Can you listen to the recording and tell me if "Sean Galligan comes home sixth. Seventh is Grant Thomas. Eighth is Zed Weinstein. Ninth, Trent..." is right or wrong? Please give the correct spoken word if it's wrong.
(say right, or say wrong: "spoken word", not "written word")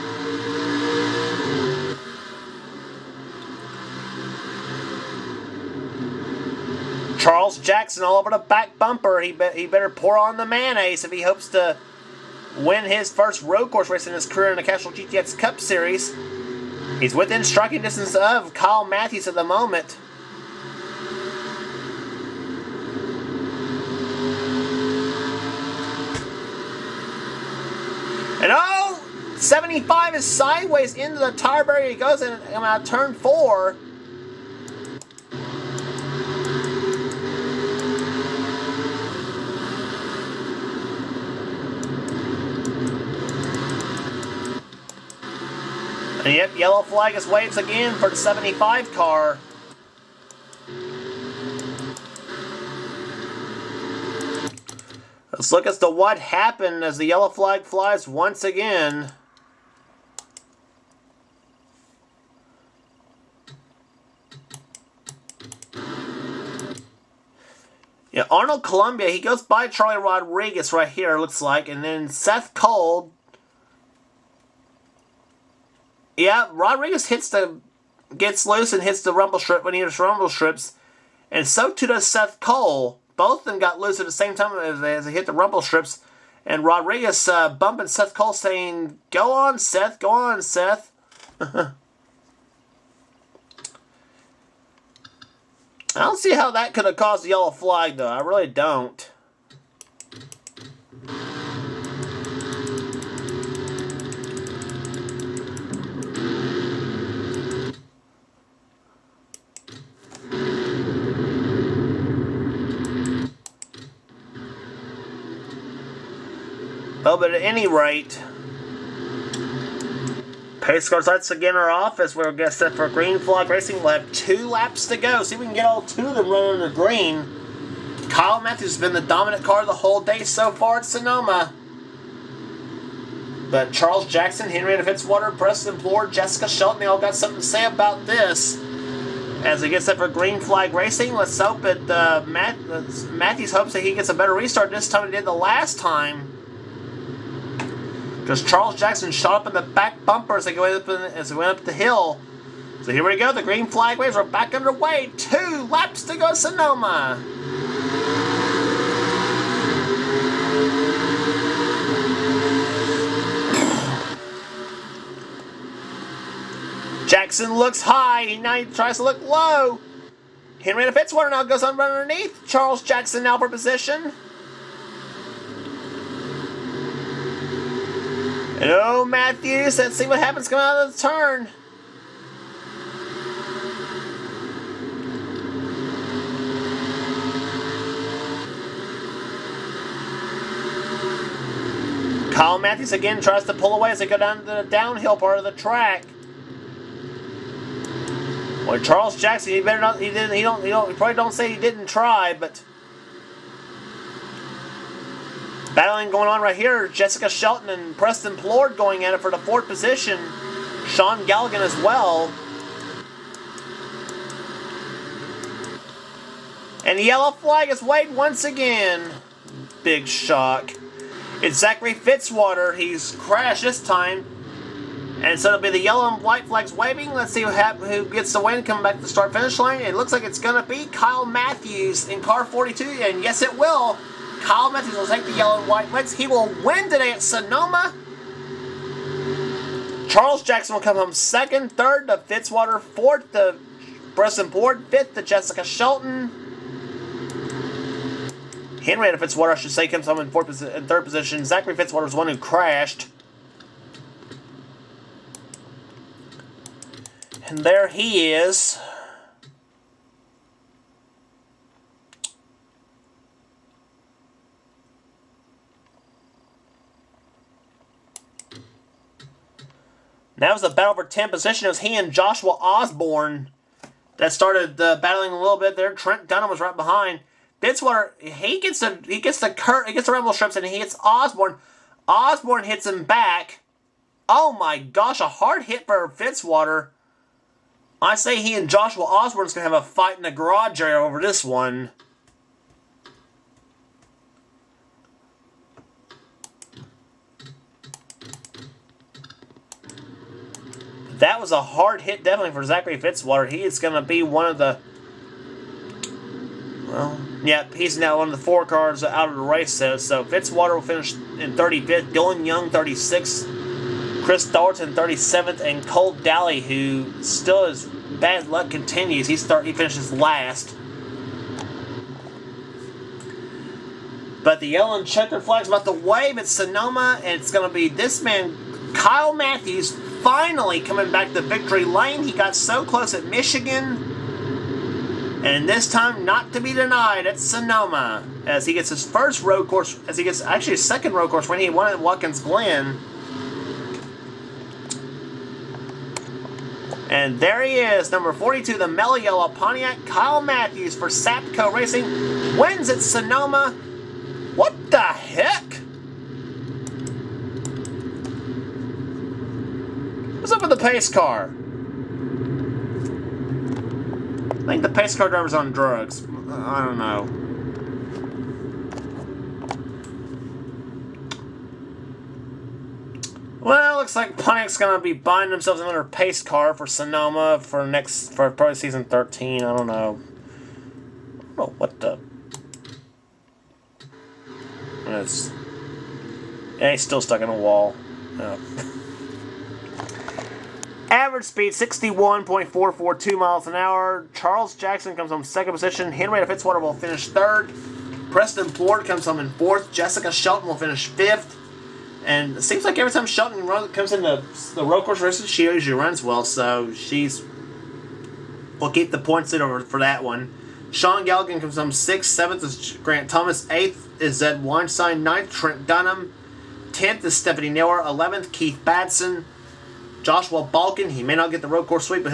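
right.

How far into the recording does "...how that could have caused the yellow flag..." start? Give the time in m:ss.
1:36.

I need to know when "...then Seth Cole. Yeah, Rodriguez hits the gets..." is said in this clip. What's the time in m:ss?
1:11.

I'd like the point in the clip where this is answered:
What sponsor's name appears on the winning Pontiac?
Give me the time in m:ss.
5:48.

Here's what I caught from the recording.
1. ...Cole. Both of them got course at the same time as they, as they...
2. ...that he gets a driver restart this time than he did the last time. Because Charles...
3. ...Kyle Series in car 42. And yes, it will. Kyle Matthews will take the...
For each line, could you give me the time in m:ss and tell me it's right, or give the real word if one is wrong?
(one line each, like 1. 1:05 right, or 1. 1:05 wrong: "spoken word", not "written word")
1. 1:22 wrong: "loose", not "course"
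2. 2:23 wrong: "better", not "driver"
3. 3:50 wrong: "Matthews", not "Series".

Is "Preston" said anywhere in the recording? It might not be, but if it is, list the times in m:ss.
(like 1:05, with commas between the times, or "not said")
2:15, 3:27, 6:38.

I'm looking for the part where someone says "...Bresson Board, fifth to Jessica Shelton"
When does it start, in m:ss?
4:04.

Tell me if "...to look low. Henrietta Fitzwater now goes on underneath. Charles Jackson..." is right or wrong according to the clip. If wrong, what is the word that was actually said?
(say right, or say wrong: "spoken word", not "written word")
right.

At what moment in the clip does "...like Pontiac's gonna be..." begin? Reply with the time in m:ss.
6:14.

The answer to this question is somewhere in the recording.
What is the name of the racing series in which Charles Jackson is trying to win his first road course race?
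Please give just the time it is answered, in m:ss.
0:14.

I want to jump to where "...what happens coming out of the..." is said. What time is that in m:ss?
3:00.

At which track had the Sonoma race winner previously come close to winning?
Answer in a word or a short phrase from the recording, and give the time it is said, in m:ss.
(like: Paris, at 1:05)
Michigan, at 5:33.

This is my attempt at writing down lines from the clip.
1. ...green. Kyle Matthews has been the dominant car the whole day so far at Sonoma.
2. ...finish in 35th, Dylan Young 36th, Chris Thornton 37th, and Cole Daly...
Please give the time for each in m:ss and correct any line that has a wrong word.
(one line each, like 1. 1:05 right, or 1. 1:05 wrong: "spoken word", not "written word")
1. 2:06 right
2. 5:10 right.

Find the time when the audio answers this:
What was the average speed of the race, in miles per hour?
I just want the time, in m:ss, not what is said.
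6:31.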